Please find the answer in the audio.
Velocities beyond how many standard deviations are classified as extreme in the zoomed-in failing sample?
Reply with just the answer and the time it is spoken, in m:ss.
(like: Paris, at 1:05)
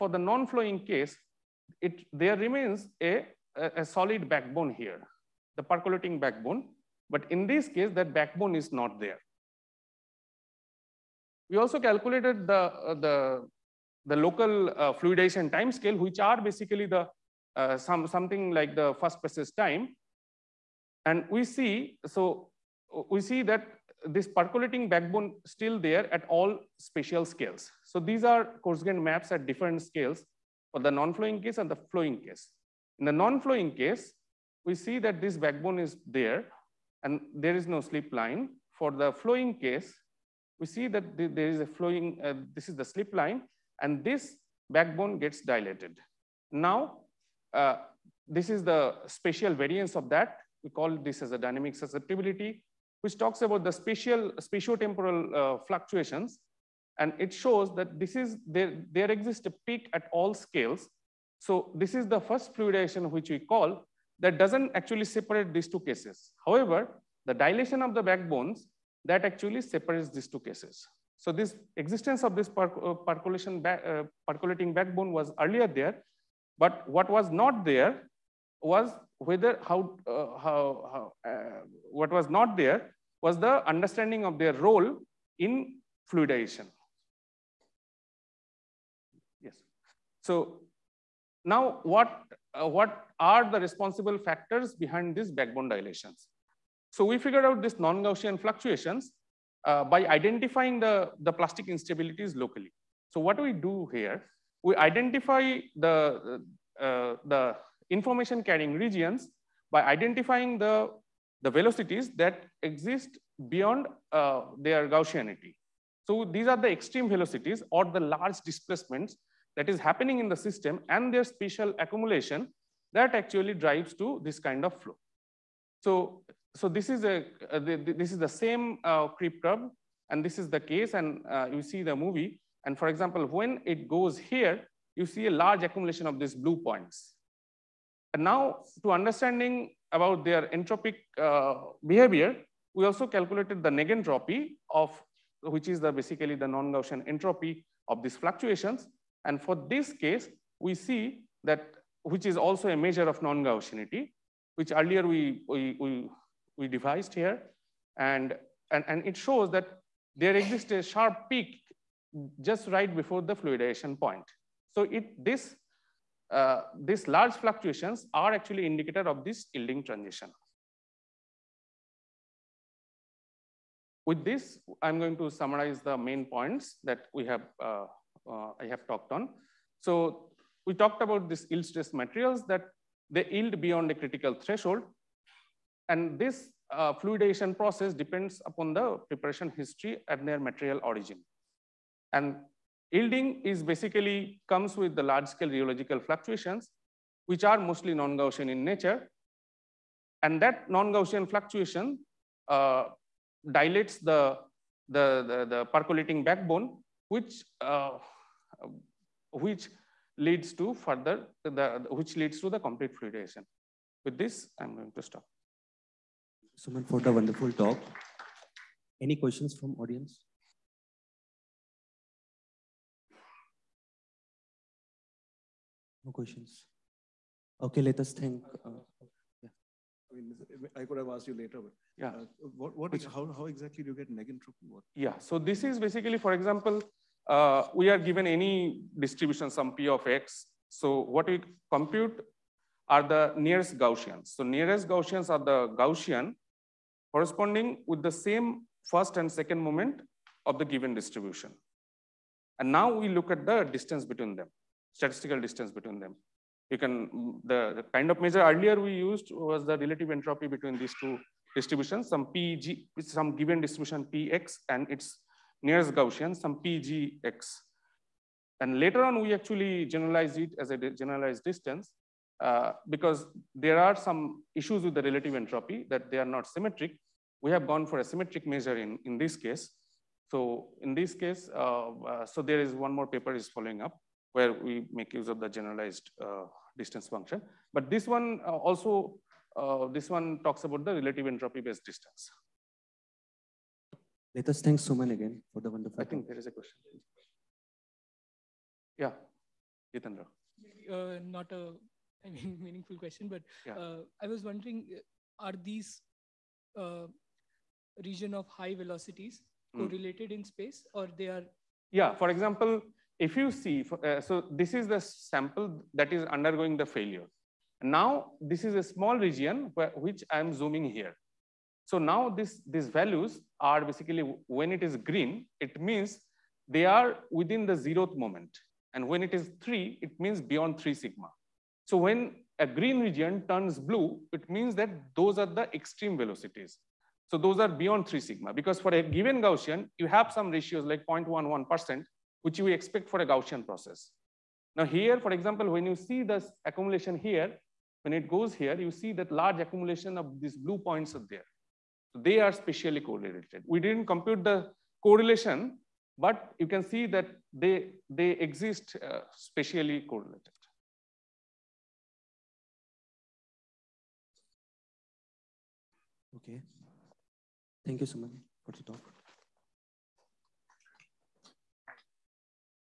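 3 sigma, at 5:38.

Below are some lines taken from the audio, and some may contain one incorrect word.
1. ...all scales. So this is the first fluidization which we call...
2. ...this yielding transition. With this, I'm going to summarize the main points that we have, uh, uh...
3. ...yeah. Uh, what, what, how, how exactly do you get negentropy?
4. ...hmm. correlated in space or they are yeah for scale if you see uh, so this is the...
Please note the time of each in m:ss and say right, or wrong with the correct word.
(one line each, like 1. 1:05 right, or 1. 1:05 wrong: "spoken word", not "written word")
1. 1:00 right
2. 2:49 right
3. 3:51 right
4. 5:09 wrong: "example", not "scale".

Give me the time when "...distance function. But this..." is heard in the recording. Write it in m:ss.
4:46.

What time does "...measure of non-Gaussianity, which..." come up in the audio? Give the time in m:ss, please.
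2:32.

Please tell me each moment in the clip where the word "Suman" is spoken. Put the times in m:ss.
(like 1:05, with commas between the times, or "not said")
3:36, 4:54.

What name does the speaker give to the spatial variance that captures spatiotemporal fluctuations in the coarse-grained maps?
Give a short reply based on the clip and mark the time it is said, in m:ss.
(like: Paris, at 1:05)
Dynamic susceptibility, at 0:51.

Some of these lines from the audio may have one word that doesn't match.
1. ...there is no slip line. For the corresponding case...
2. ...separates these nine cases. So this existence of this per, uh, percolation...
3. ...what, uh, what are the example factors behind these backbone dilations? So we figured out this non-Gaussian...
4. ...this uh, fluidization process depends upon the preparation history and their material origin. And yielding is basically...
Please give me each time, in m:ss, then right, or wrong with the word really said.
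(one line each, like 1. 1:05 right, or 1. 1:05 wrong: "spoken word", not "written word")
1. 0:37 wrong: "flowing", not "corresponding"
2. 1:09 wrong: "two", not "nine"
3. 1:31 wrong: "responsible", not "example"
4. 3:06 right.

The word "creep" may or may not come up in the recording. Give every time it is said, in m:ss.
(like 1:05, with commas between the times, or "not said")
2:09.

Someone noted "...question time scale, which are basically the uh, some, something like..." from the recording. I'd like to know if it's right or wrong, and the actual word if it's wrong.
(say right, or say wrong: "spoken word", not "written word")
wrong: "fluidization", not "question".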